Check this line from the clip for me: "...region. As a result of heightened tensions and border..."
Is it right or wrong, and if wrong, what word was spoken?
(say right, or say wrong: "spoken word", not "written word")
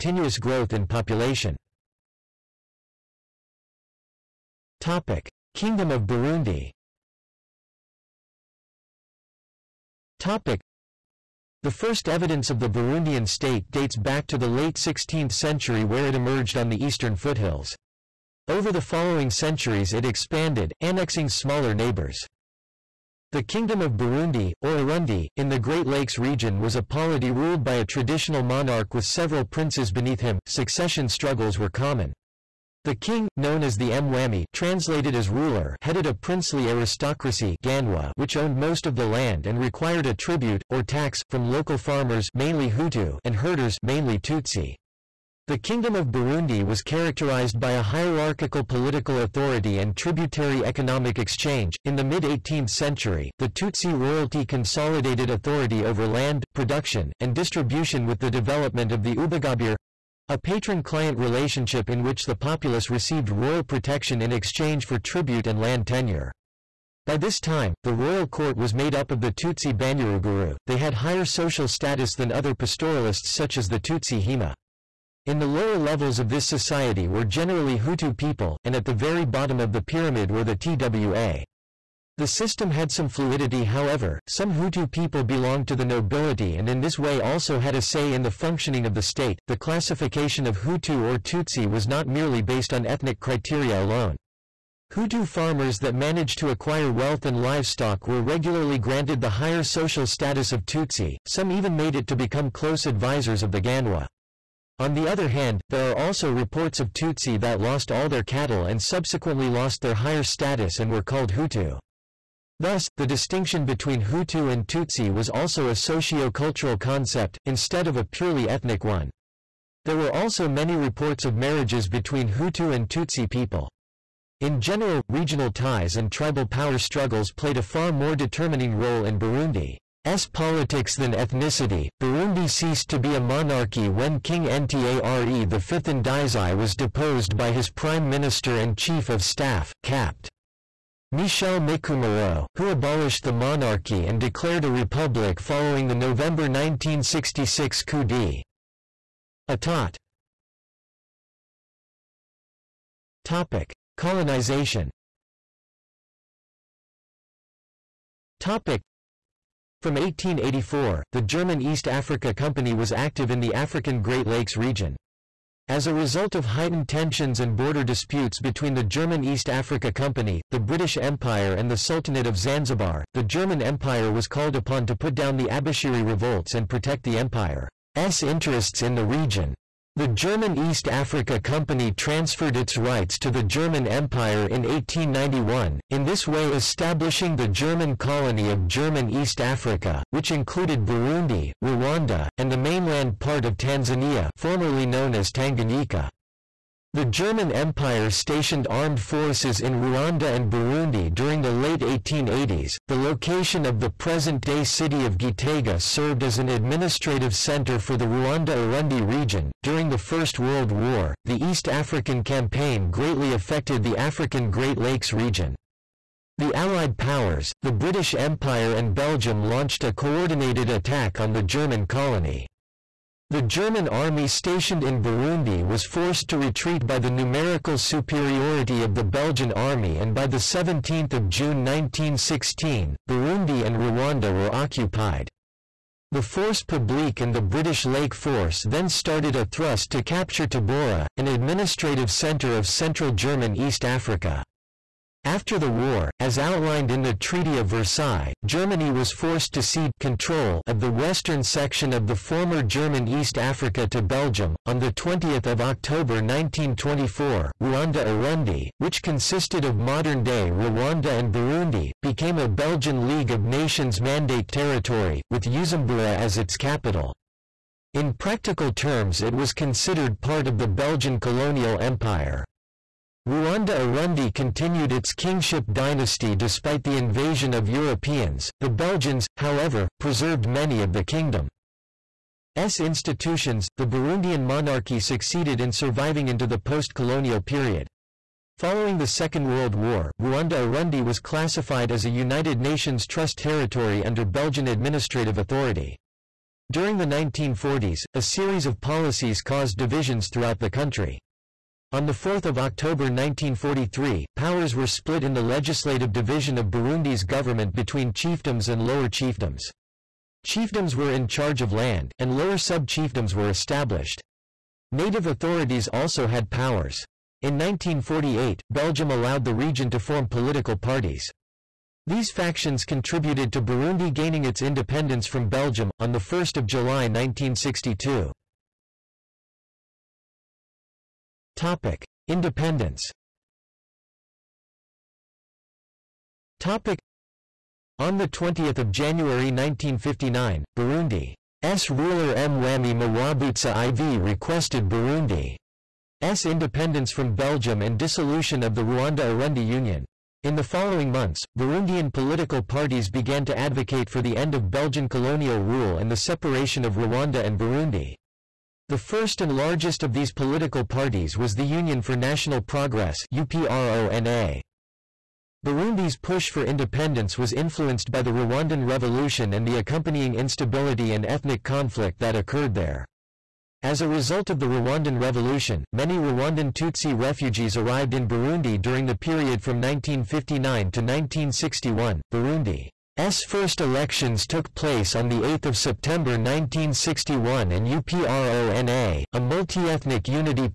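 right.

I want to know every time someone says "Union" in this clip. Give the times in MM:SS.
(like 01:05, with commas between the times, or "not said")
05:49, 06:01.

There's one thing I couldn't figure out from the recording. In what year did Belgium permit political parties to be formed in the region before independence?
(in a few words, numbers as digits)
1948.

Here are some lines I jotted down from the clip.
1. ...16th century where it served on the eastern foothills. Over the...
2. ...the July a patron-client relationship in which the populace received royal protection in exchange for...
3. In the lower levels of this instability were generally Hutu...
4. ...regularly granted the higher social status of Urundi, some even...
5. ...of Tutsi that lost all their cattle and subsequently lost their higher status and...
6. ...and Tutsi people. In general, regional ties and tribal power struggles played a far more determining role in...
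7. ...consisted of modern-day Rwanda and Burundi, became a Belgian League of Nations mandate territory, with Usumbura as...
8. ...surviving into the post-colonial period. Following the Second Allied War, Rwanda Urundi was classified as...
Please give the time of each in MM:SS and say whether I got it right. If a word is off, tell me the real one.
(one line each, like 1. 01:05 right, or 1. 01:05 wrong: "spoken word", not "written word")
1. 00:14 wrong: "emerged", not "served"
2. 00:59 wrong: "Ubugabire", not "July"
3. 01:15 wrong: "society", not "instability"
4. 01:38 wrong: "Tutsi", not "Urundi"
5. 01:46 right
6. 02:02 right
7. 04:19 right
8. 04:45 wrong: "World", not "Allied".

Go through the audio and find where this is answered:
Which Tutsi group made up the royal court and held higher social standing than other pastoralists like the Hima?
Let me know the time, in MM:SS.
01:09.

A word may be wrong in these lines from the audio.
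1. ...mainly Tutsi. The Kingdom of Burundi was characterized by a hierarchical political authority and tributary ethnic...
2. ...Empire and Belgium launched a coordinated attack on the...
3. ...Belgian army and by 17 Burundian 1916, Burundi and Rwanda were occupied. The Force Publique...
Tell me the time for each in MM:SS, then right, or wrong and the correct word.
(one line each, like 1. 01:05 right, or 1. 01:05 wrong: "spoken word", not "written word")
1. 00:43 wrong: "economic", not "ethnic"
2. 03:38 right
3. 03:49 wrong: "June", not "Burundian".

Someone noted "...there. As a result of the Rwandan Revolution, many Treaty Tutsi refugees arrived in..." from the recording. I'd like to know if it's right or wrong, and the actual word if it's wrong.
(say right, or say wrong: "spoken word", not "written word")
wrong: "Rwandan", not "Treaty".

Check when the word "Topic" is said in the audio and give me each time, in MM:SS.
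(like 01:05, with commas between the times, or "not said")
05:31, 05:36.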